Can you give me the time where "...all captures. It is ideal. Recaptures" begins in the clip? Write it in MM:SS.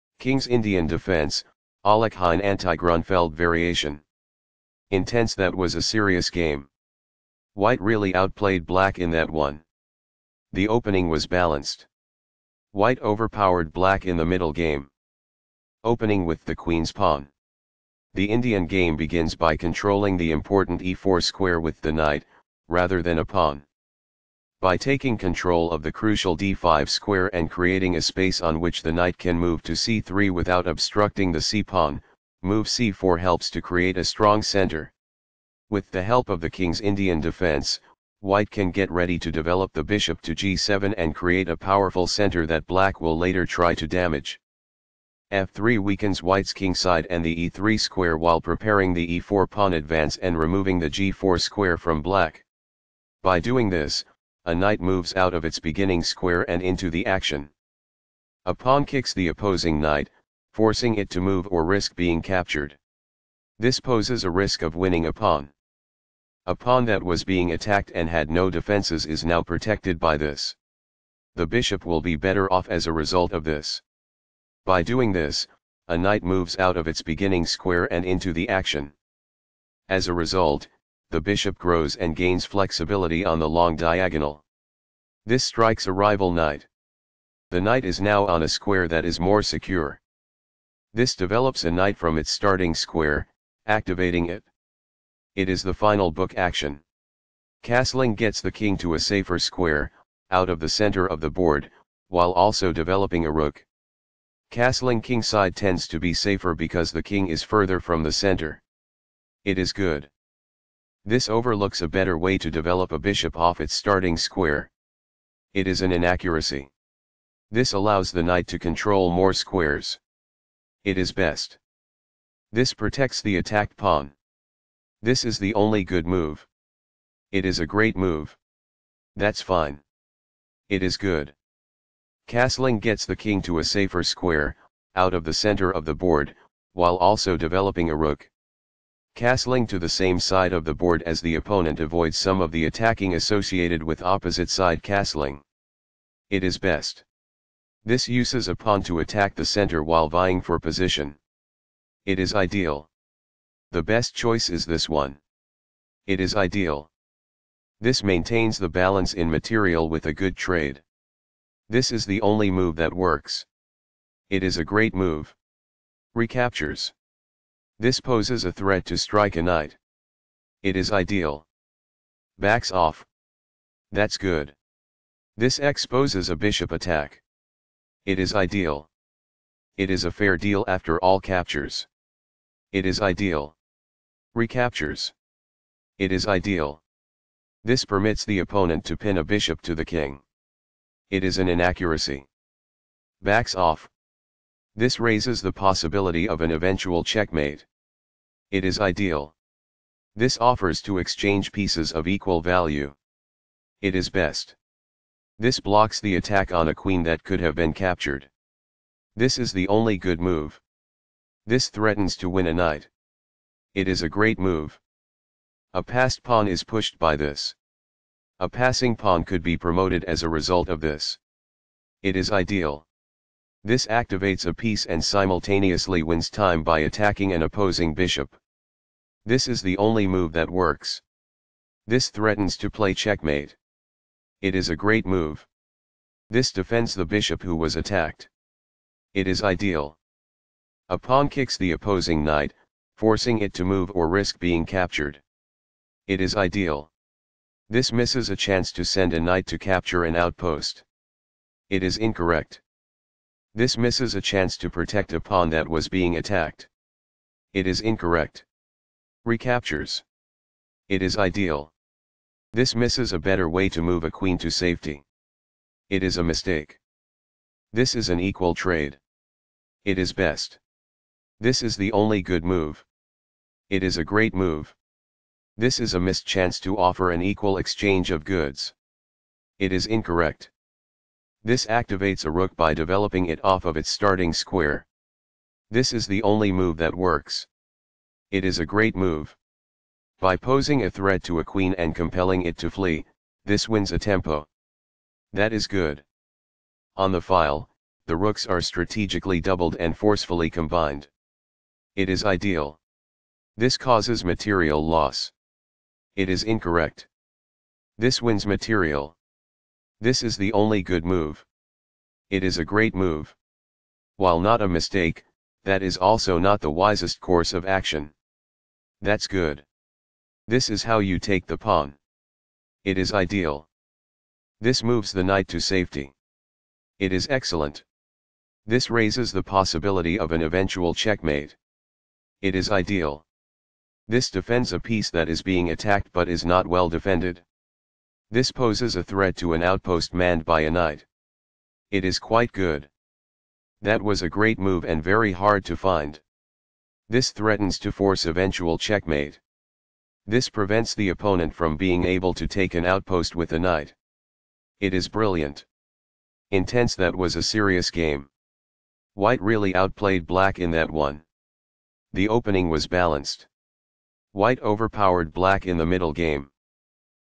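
03:00.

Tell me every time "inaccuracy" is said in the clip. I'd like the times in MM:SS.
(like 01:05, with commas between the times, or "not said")
01:55, 03:11.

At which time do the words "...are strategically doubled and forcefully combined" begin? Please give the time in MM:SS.
04:58.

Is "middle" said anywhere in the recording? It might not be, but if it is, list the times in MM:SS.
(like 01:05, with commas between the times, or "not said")
00:14, 06:05.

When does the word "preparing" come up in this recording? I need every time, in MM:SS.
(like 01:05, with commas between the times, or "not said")
00:48.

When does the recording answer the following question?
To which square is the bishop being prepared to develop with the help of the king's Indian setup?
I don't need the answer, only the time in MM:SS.
00:40.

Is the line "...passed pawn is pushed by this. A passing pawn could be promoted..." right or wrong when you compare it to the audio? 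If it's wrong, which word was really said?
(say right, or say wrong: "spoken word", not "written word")
right.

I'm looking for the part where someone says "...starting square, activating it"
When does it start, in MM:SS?
01:32.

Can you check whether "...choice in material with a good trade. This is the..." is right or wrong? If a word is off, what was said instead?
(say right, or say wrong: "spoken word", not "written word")
wrong: "balance", not "choice".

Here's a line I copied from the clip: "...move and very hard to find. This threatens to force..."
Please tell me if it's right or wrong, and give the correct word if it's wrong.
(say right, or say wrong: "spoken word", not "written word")
right.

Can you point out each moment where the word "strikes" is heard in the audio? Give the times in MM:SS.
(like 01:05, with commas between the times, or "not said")
01:25, 02:48.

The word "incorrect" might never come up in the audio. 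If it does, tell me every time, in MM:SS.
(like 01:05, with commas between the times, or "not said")
04:11, 04:17, 04:39, 05:06.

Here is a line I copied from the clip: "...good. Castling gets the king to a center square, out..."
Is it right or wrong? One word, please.
wrong.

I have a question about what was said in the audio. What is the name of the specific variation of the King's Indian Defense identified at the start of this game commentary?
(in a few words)
Alekhine anti-Grunfeld.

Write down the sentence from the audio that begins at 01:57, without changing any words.
This allows the knight to control more squares.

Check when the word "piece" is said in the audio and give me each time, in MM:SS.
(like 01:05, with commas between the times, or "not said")
03:21, 03:44, 05:34.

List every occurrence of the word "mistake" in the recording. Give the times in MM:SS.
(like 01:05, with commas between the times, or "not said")
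04:26, 05:14.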